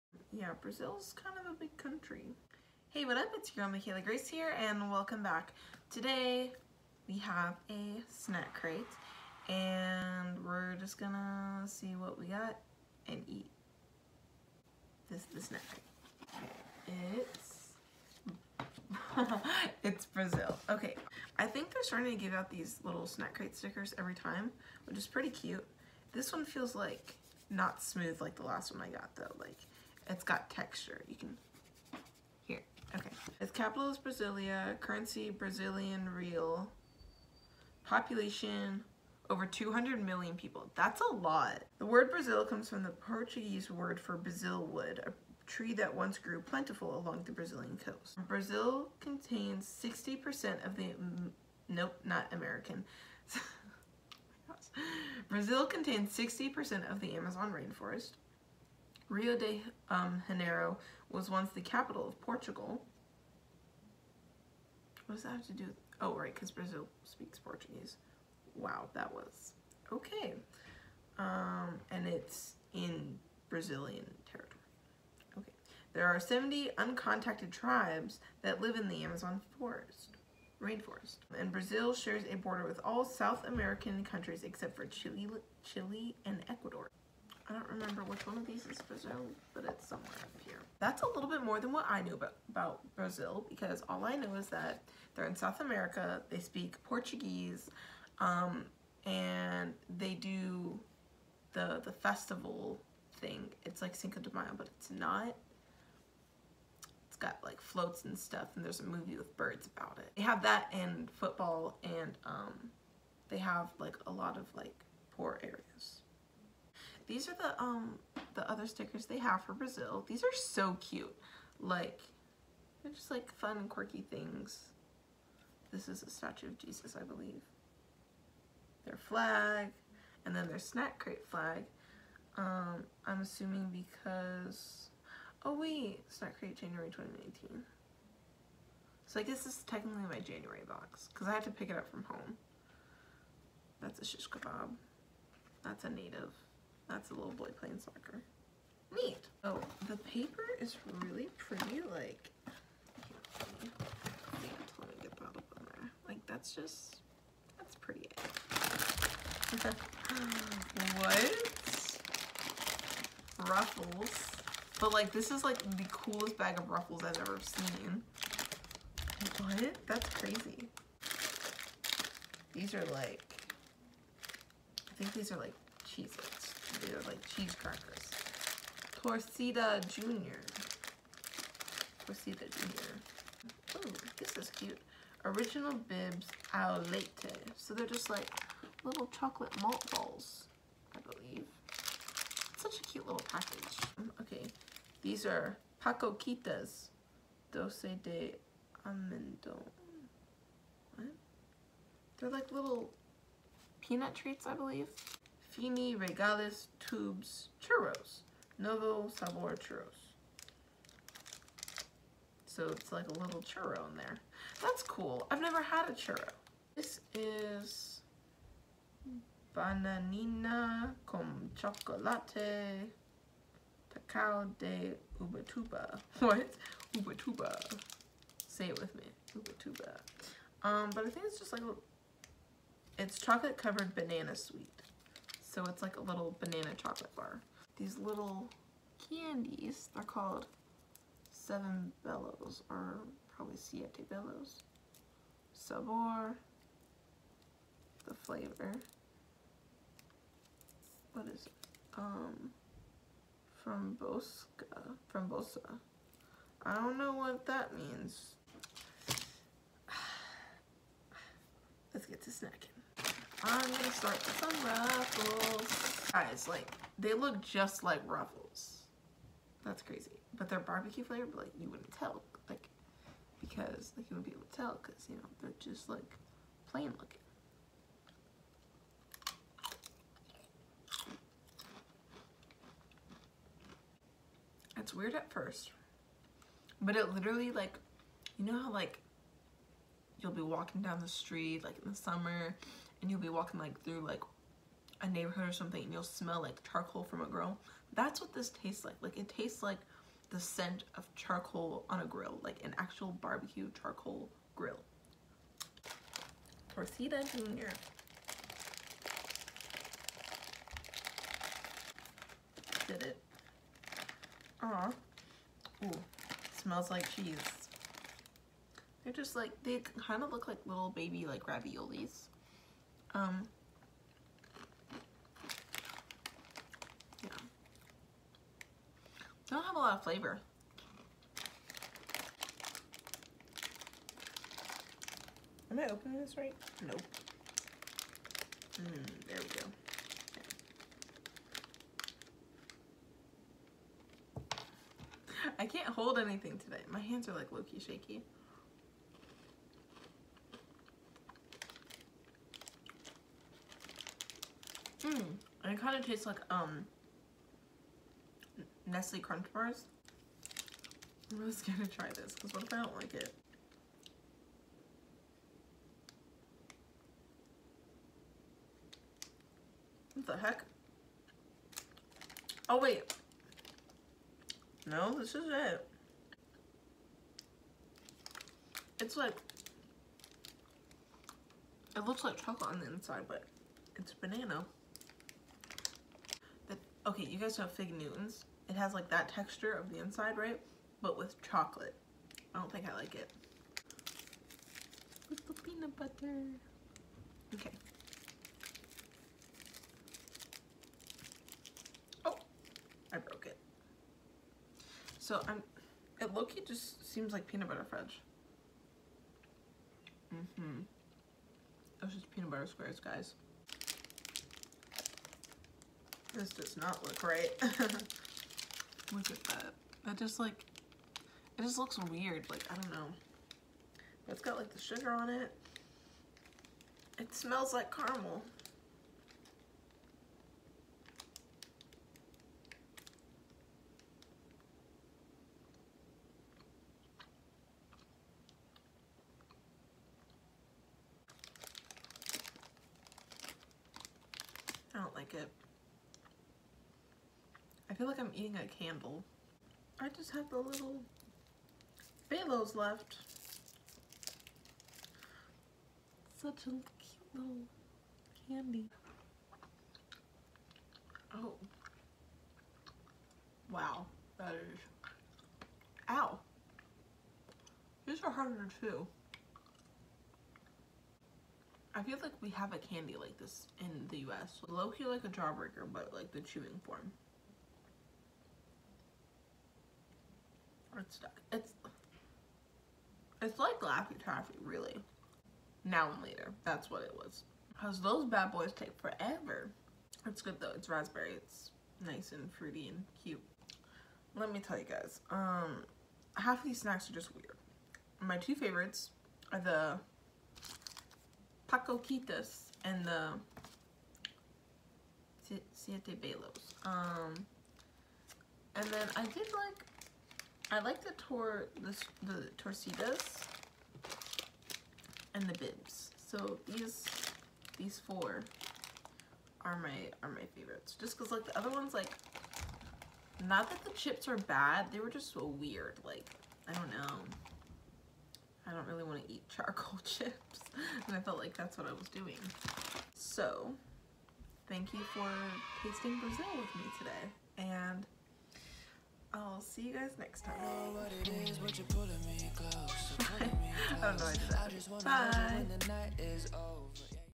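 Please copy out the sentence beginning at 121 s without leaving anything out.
Like, they're just like fun and quirky things.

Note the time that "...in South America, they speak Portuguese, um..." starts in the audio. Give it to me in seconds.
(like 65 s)
95 s.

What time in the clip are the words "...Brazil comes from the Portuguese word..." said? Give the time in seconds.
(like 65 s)
42 s.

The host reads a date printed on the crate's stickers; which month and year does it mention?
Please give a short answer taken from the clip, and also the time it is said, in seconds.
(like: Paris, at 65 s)
January 2019, at 136 s.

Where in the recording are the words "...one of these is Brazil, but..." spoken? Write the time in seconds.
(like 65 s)
88 s.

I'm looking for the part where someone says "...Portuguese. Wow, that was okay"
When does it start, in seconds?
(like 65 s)
67 s.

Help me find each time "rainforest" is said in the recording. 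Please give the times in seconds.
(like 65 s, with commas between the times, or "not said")
57 s, 80 s.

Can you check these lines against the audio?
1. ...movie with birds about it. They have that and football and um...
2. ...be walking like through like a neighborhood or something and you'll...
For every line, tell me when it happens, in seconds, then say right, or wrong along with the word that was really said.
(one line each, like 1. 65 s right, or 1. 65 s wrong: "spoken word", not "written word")
1. 108 s right
2. 293 s right.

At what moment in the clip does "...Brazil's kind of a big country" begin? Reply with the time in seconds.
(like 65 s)
0 s.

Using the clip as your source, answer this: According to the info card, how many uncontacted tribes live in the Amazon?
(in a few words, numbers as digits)
70.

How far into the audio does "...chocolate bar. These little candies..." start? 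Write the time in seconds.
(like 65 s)
236 s.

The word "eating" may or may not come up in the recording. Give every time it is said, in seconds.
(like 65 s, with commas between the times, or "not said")
448 s.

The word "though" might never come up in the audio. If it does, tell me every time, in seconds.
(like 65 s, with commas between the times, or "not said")
29 s, 490 s.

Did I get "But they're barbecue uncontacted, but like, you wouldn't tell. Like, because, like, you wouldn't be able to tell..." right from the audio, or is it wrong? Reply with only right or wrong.
wrong.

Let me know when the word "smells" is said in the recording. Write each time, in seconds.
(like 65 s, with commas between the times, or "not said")
296 s, 316 s, 427 s.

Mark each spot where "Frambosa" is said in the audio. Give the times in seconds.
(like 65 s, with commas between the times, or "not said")
255 s.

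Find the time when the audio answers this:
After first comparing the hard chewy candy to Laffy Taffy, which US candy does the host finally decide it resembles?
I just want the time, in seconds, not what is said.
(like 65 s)
485 s.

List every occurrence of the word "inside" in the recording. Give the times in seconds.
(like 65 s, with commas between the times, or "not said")
382 s, 390 s.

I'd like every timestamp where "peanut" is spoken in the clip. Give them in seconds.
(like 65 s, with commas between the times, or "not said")
203 s, 395 s, 407 s, 412 s.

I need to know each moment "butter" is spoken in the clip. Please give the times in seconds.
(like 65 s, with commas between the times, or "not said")
395 s, 407 s, 412 s.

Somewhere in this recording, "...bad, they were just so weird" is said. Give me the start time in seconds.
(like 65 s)
524 s.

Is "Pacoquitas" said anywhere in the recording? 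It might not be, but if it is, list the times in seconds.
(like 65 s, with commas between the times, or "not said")
195 s, 501 s.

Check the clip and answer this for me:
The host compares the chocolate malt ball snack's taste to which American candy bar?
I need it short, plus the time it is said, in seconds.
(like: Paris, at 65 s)
Nestle Crunch Bars, at 358 s.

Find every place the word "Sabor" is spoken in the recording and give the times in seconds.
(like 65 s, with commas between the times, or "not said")
209 s, 245 s.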